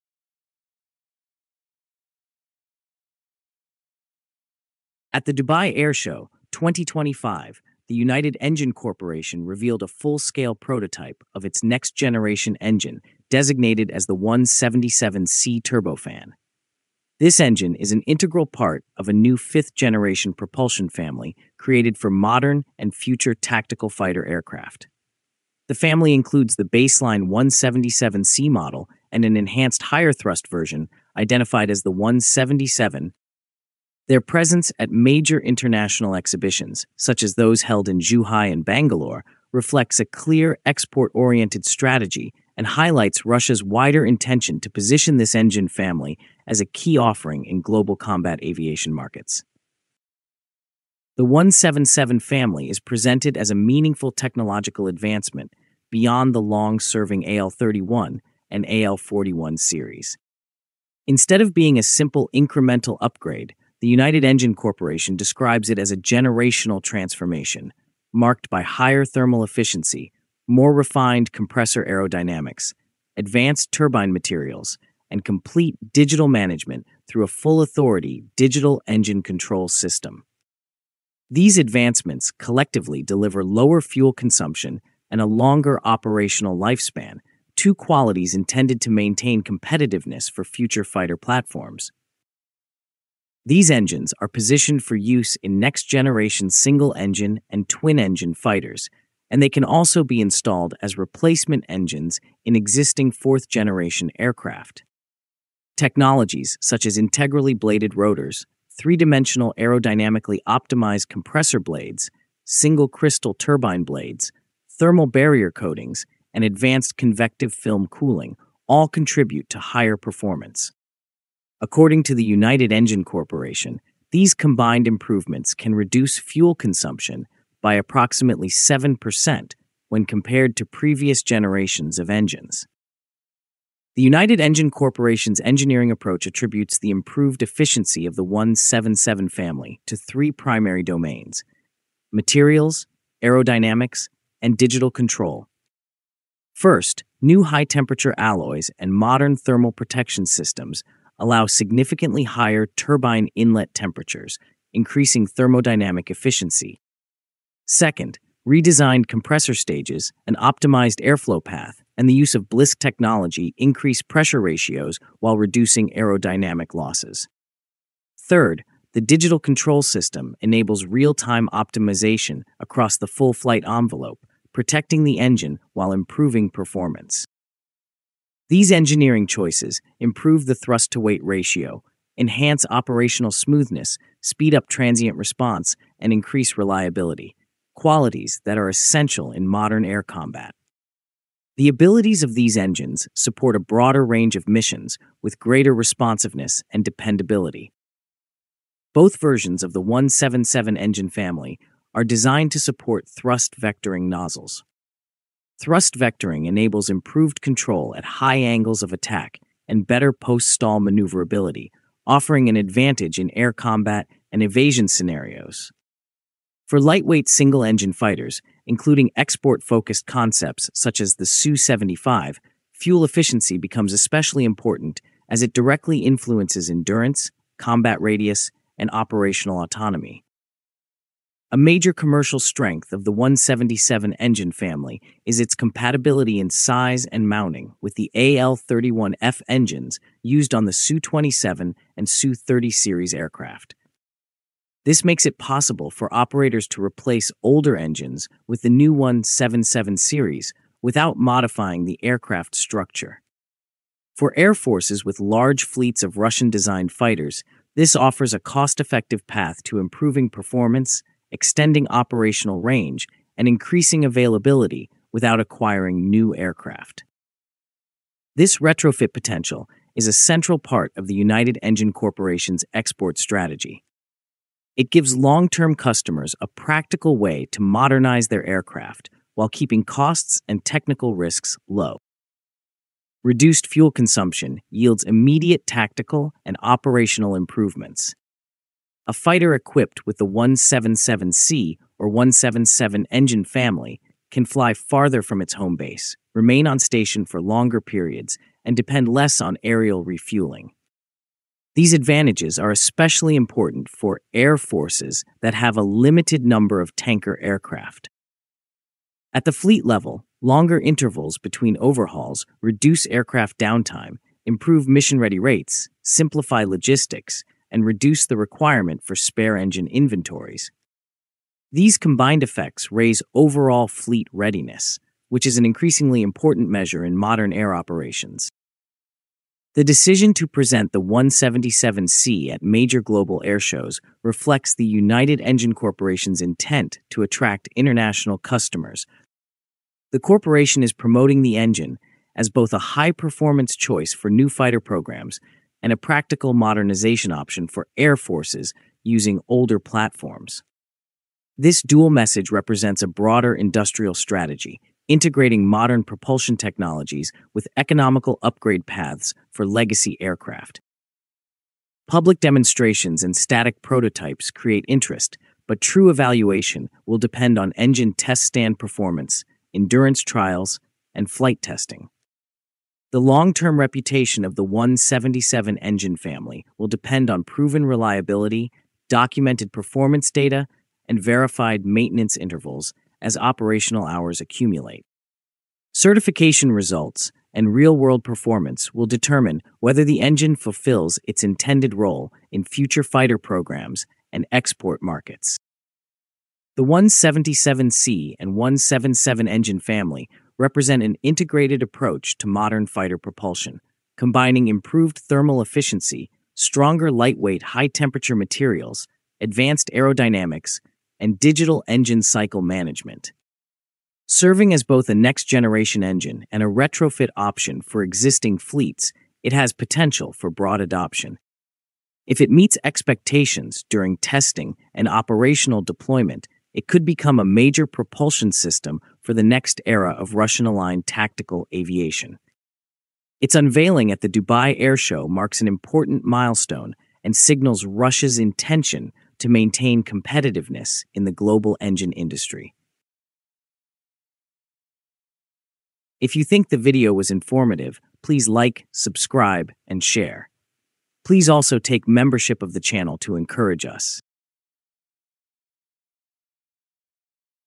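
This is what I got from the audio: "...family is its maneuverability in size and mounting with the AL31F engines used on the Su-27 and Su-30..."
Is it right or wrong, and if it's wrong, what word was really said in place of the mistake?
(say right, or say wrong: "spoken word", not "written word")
wrong: "compatibility", not "maneuverability".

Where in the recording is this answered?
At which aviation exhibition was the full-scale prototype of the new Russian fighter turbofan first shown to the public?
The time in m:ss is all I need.
0:05.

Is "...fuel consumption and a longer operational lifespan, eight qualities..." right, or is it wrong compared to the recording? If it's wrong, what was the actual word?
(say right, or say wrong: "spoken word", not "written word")
wrong: "two", not "eight".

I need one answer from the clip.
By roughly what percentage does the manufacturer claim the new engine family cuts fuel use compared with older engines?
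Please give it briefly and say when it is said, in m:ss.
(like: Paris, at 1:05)
7%, at 2:08.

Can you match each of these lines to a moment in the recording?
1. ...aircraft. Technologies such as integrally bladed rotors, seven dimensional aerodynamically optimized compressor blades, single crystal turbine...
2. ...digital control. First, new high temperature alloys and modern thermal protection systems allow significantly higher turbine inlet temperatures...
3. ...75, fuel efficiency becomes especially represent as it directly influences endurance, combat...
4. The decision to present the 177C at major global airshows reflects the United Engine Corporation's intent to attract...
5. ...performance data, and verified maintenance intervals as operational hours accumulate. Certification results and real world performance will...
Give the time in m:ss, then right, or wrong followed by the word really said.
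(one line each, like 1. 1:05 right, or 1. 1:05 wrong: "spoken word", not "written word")
1. 1:44 wrong: "three", not "seven"
2. 2:24 right
3. 3:41 wrong: "important", not "represent"
4. 5:29 right
5. 6:19 right.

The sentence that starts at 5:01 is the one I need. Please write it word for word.
These advantages are especially important for air forces that have a limited number of tanker aircraft.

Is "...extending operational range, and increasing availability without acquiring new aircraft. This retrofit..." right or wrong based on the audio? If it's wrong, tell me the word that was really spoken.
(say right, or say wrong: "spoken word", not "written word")
right.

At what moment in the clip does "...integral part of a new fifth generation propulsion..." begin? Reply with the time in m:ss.
0:18.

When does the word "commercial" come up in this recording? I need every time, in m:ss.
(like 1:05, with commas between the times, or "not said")
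3:51.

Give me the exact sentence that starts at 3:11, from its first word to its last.
The abilities of these engines support a broader range of missions with greater responsiveness and dependability.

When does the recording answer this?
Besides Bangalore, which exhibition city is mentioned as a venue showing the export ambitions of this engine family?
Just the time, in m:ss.
0:37.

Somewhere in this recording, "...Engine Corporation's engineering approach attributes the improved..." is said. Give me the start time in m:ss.
2:14.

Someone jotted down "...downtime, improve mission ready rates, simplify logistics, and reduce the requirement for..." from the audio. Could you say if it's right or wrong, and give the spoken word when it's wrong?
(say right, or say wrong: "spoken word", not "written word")
right.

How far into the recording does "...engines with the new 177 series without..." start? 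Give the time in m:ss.
4:07.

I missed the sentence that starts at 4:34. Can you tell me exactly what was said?
It gives long term customers a practical way to modernize their aircraft while keeping costs and technical risks low.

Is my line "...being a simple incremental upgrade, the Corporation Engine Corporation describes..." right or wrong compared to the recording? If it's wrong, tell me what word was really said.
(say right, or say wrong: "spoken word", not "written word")
wrong: "United", not "Corporation".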